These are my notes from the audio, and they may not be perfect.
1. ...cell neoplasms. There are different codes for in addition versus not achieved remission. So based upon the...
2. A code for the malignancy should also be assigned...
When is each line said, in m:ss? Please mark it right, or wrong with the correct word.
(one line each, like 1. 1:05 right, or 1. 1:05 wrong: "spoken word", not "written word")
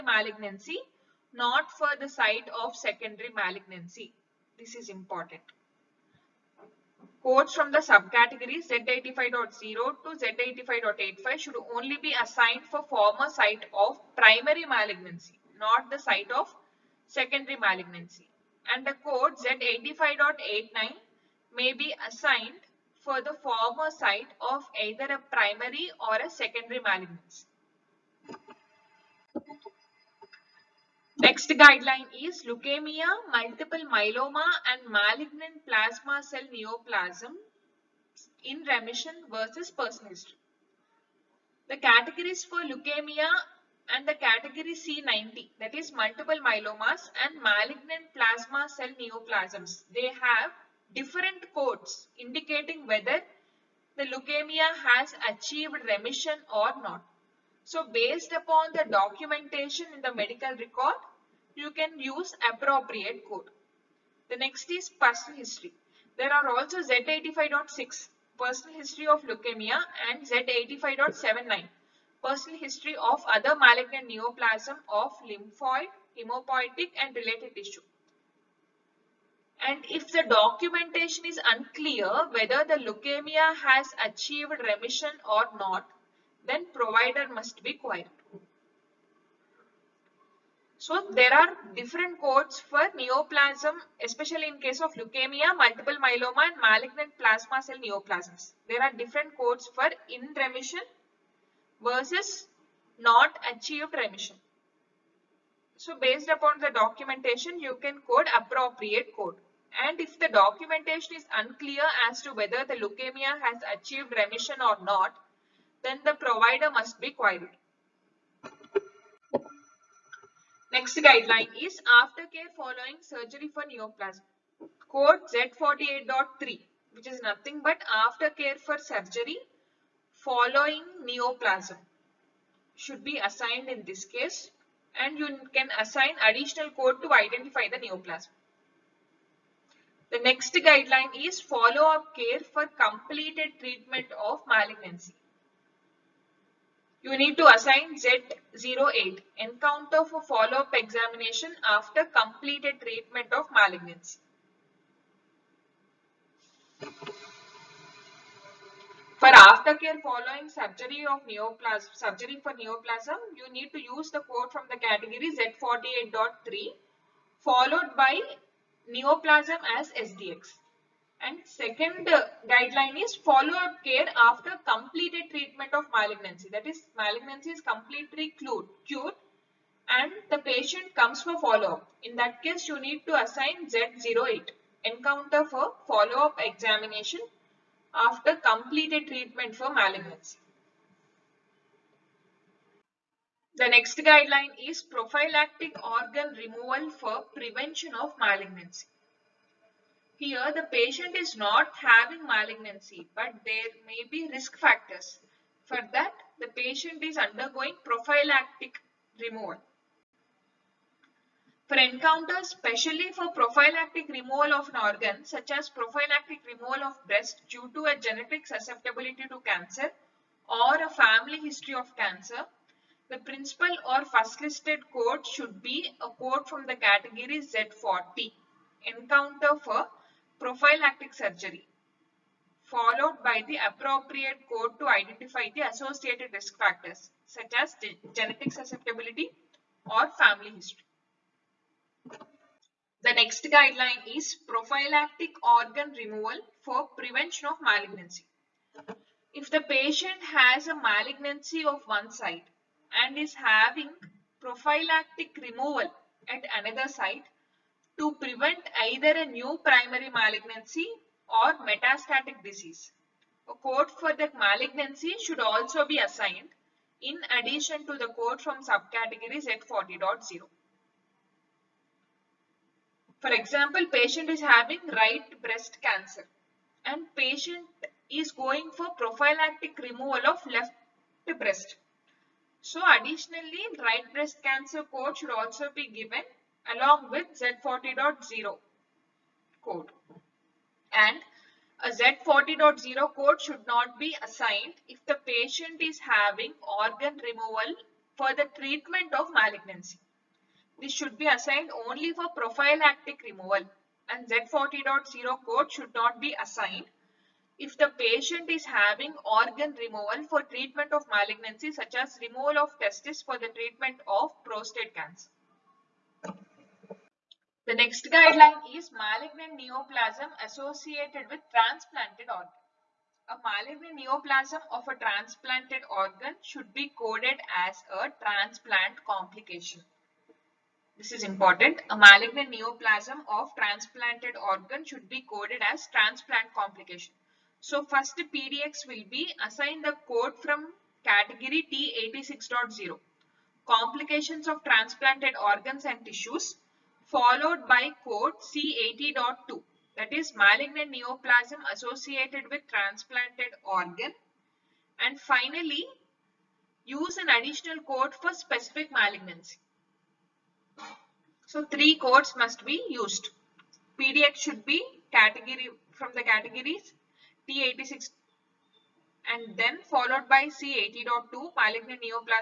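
1. 1:37 wrong: "remission", not "addition"
2. 4:23 right.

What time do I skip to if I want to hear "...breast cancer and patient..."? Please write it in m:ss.
4:35.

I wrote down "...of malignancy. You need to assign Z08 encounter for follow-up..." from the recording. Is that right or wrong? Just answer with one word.
right.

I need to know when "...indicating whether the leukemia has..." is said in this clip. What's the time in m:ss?
0:52.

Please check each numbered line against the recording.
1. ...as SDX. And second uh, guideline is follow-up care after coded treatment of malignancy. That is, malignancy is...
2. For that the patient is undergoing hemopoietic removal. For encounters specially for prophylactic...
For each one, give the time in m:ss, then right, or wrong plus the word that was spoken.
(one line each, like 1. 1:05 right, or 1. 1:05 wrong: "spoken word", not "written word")
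1. 2:49 wrong: "completed", not "coded"
2. 3:25 wrong: "prophylactic", not "hemopoietic".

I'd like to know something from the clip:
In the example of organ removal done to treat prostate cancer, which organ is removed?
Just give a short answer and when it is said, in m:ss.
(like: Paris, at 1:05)
testis, at 5:12.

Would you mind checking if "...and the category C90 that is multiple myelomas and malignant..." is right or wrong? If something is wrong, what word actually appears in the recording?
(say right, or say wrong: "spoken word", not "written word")
right.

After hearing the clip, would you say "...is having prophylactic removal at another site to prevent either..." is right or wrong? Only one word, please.
right.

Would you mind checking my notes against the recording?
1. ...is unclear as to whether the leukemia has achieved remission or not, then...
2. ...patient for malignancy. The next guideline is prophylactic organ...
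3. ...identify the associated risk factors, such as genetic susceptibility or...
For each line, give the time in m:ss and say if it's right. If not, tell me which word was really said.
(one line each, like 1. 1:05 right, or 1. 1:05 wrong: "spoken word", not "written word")
1. 1:51 right
2. 3:09 wrong: "treatment", not "patient"
3. 3:54 right.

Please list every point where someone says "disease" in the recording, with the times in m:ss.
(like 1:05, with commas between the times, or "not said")
4:22.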